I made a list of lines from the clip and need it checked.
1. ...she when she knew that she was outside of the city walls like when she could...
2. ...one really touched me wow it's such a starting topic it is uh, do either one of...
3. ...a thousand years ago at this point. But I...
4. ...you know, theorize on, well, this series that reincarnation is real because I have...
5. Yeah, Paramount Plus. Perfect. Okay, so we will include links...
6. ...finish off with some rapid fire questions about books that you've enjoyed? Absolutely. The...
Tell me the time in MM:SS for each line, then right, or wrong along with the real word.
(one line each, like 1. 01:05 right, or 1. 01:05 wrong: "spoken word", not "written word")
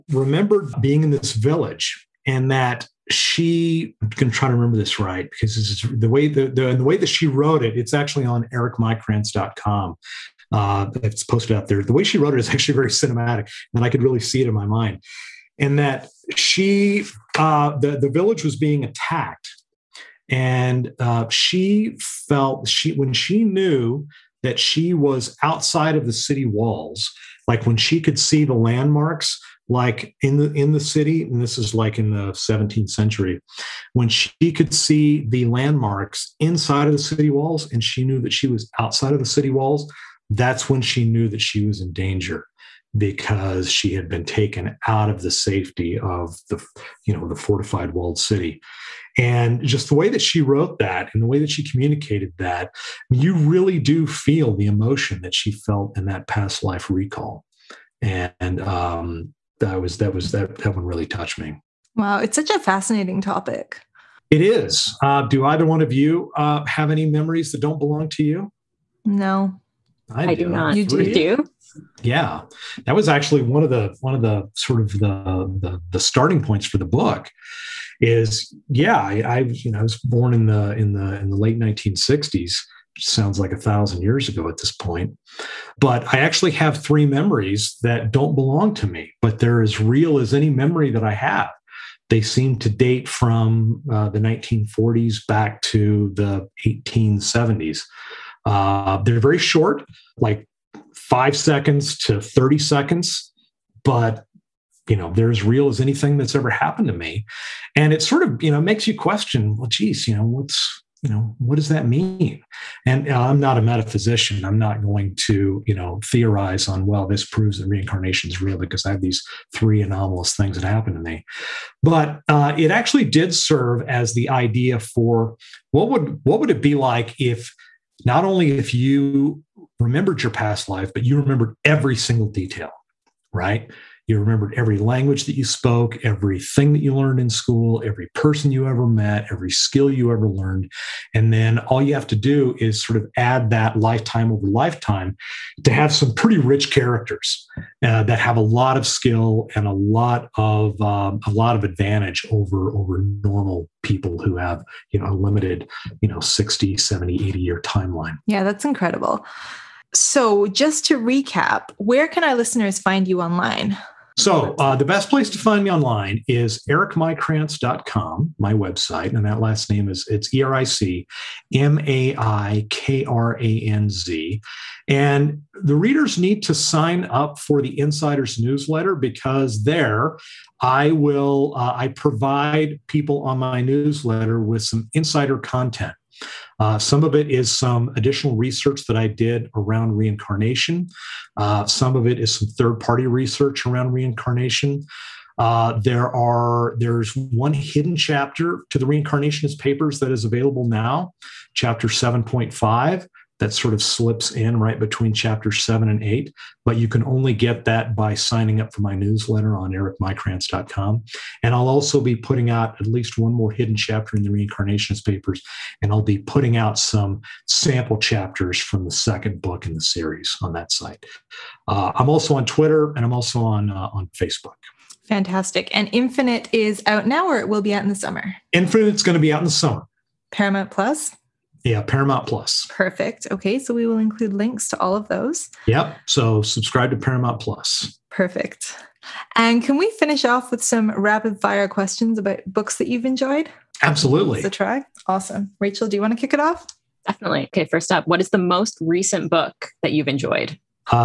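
1. 00:22 right
2. 01:00 wrong: "fascinating", not "starting"
3. 01:23 right
4. 01:55 wrong: "proves", not "series"
5. 03:51 right
6. 03:59 right.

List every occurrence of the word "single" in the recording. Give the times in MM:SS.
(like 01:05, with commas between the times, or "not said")
02:11.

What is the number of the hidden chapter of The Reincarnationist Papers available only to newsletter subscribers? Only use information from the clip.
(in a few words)
7.5.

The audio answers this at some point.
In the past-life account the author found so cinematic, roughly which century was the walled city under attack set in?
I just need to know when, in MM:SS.
00:32.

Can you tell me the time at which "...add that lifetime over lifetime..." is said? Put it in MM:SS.
02:23.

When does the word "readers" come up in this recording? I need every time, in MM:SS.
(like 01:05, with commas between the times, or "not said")
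02:55.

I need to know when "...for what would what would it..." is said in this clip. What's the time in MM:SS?
02:04.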